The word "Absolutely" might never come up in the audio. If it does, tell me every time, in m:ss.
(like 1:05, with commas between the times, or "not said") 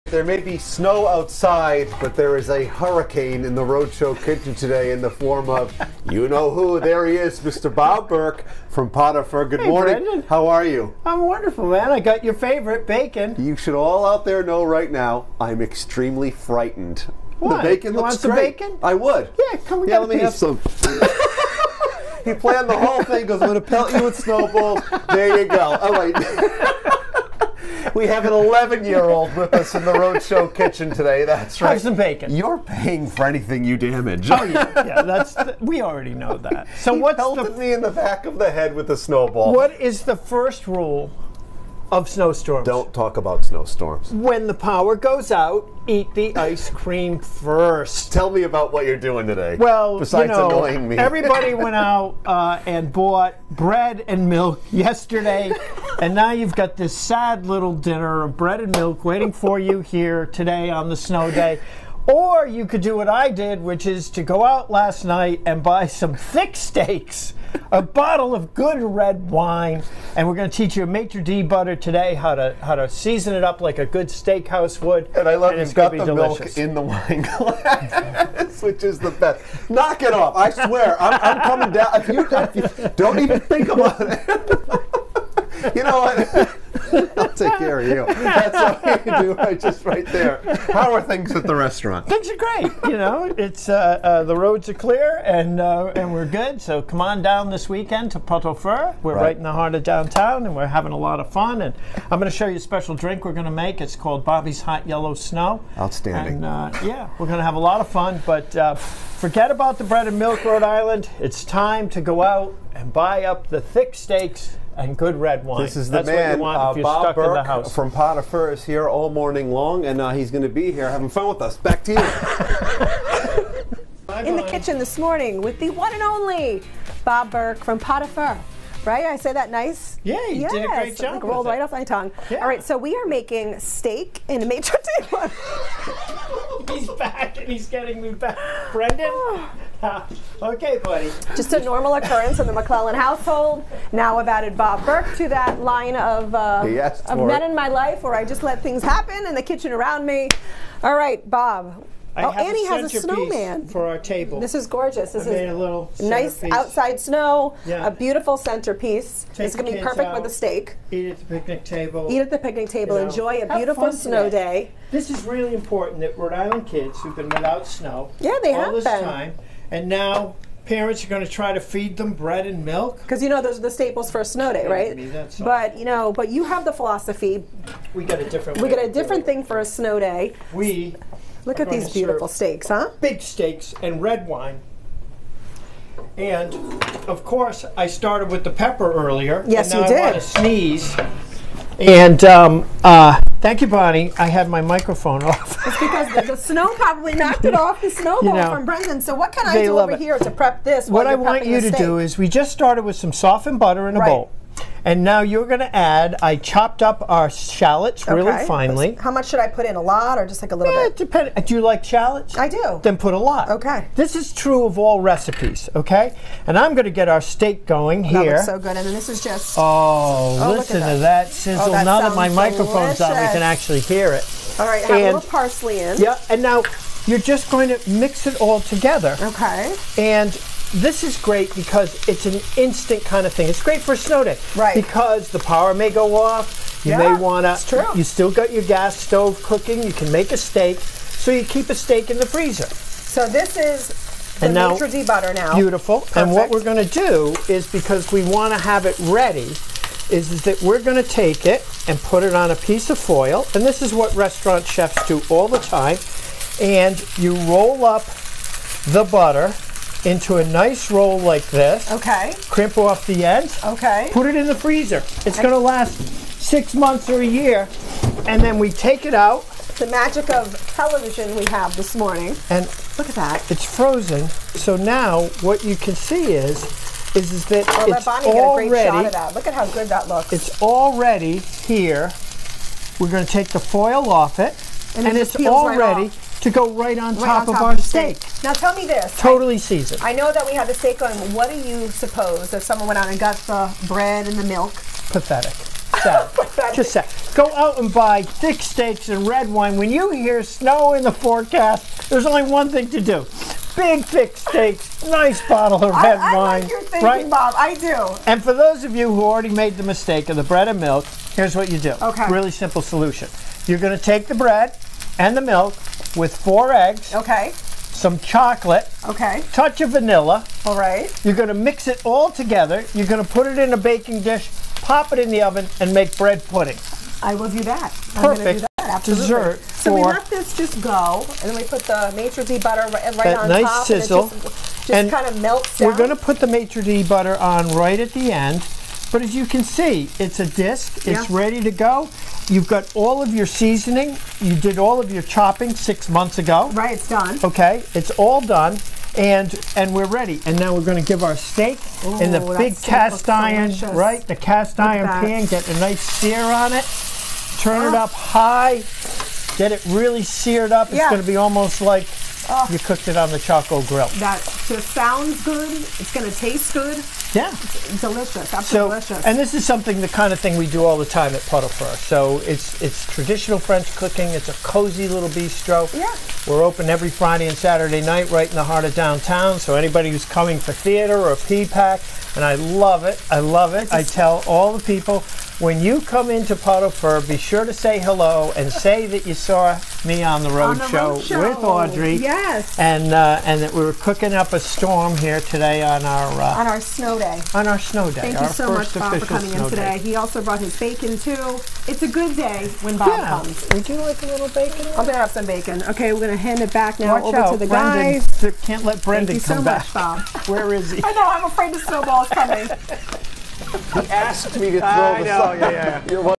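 5:28, 6:08.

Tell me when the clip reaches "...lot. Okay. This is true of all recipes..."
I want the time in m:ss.
3:33.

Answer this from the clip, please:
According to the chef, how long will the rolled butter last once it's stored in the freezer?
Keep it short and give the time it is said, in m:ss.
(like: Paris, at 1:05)
6 months or a year, at 4:26.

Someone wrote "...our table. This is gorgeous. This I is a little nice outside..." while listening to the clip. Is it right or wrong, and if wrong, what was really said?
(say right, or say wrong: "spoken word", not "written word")
right.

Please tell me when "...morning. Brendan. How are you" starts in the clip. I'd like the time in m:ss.
0:09.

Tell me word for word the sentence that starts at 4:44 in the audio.
And, and it it's already to go right on right top on of top our of steak.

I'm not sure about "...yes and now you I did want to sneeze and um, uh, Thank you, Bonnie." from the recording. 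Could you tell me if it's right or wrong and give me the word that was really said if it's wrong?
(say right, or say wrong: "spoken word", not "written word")
right.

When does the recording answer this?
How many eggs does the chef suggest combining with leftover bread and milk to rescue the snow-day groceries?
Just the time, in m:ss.
5:16.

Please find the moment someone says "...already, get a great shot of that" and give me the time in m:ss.
4:38.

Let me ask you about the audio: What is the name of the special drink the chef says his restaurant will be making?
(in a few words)
Bobby's Hot Yellow Snow.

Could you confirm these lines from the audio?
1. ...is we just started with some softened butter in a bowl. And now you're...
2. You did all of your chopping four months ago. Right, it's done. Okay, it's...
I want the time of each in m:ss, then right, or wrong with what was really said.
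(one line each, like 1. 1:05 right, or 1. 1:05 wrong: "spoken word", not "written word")
1. 3:21 right
2. 5:44 wrong: "six", not "four".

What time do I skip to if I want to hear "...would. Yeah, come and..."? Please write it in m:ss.
0:18.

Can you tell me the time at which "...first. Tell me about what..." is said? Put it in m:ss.
0:47.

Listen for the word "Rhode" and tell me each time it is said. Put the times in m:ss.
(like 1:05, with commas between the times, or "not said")
0:03, 0:29, 1:50, 2:46, 6:31.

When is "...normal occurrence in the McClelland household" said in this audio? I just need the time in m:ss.
2:21.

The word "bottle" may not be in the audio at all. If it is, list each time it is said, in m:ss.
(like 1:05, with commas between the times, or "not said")
1:07, 5:05.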